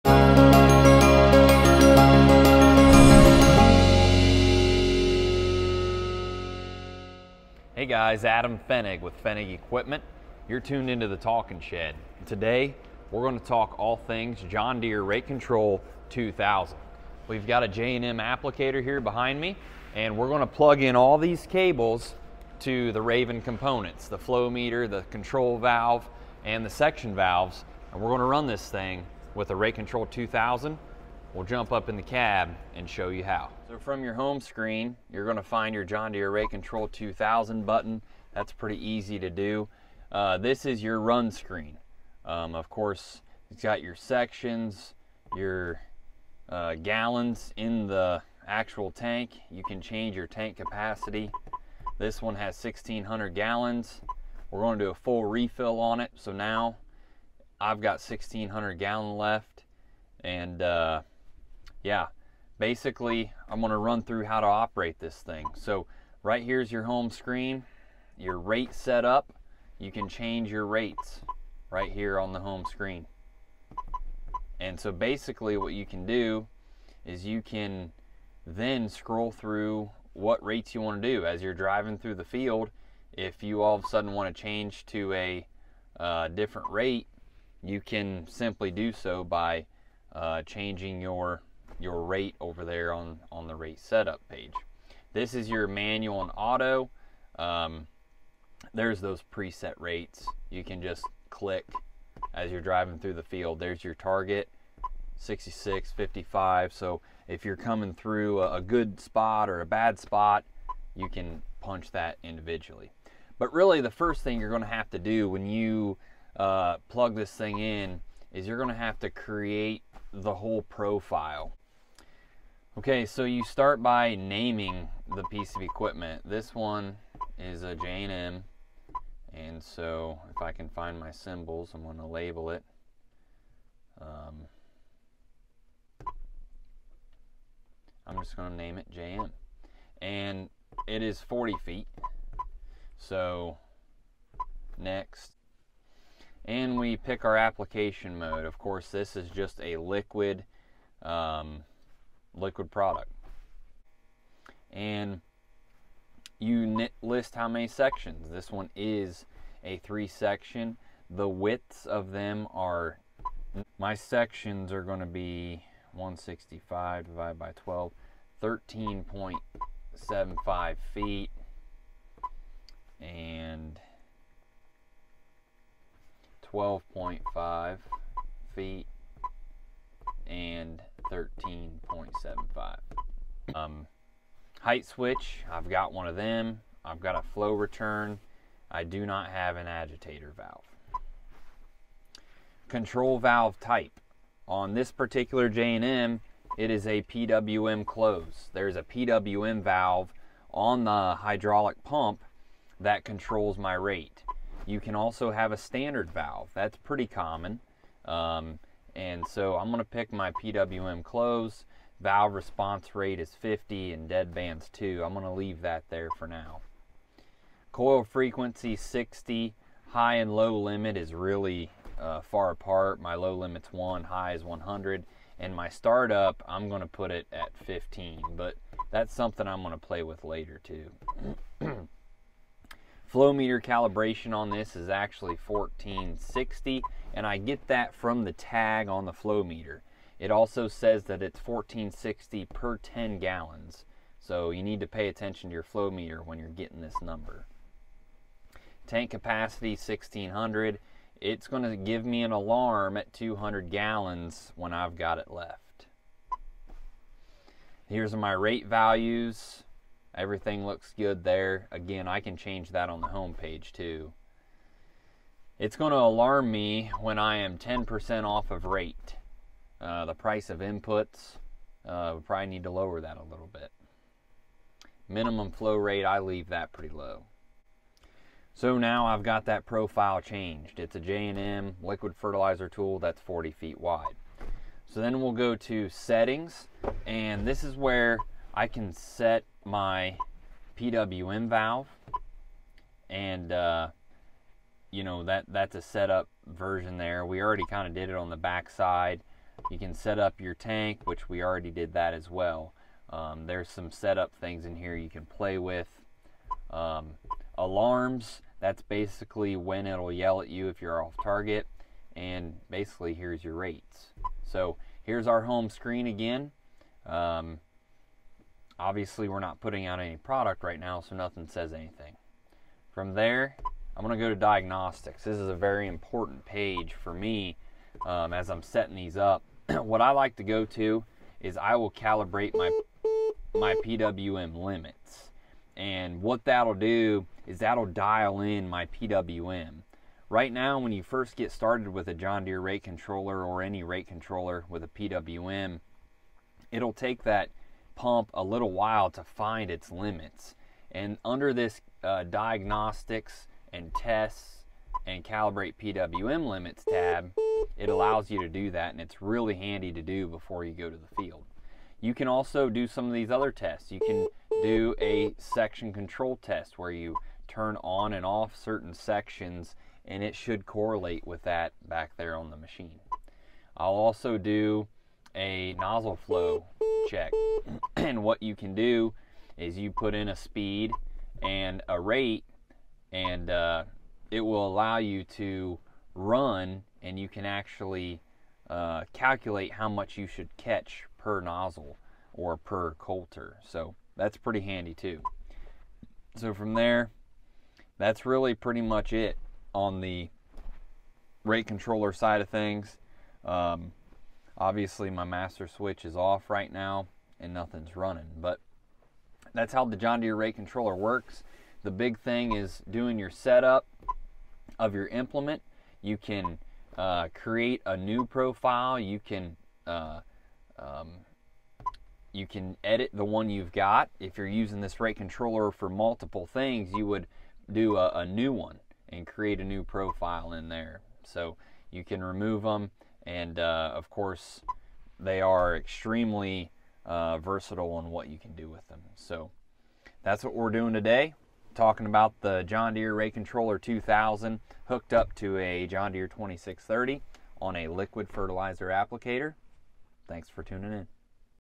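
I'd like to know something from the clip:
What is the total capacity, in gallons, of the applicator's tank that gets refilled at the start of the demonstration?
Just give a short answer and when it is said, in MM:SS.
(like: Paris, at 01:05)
1,600, at 00:52.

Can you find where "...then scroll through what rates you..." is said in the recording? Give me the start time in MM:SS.
01:18.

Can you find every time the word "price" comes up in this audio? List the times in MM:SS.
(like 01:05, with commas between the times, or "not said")
04:30.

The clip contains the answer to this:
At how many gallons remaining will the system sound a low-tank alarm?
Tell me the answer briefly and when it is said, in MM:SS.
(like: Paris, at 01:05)
200, at 04:13.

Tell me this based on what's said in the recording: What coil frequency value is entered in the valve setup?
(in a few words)
60.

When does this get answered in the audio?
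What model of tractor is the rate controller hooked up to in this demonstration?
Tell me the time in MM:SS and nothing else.
07:25.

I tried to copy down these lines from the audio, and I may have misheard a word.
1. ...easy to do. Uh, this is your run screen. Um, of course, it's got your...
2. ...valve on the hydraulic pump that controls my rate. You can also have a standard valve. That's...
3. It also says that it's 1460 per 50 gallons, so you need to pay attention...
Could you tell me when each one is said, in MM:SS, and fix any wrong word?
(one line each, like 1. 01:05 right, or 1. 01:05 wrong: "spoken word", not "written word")
1. 00:38 right
2. 03:19 right
3. 04:00 wrong: "10", not "50".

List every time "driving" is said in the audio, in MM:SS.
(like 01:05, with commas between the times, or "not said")
01:21, 01:42.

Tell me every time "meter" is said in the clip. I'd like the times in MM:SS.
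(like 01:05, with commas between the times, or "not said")
00:24, 03:53, 03:59, 04:05.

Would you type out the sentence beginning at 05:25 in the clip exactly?
This is a very important page for me um, as I'm setting these up.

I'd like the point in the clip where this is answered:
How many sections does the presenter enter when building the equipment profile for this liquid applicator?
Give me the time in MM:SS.
02:39.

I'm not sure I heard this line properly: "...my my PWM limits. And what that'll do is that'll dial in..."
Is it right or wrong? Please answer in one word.
right.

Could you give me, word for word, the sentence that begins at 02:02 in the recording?
Okay, so you start by naming the piece of equipment.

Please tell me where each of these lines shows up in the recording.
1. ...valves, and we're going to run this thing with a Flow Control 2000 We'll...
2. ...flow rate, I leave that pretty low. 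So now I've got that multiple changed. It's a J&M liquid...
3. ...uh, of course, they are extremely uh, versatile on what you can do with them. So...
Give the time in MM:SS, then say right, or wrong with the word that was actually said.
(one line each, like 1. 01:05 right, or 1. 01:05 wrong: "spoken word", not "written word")
1. 00:27 wrong: "Rate", not "Flow"
2. 04:35 wrong: "profile", not "multiple"
3. 07:13 right.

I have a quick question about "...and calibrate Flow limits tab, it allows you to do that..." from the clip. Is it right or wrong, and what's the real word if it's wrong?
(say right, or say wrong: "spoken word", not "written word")
wrong: "PWM", not "Flow".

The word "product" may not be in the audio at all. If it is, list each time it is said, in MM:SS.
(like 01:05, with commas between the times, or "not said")
02:32, 05:20.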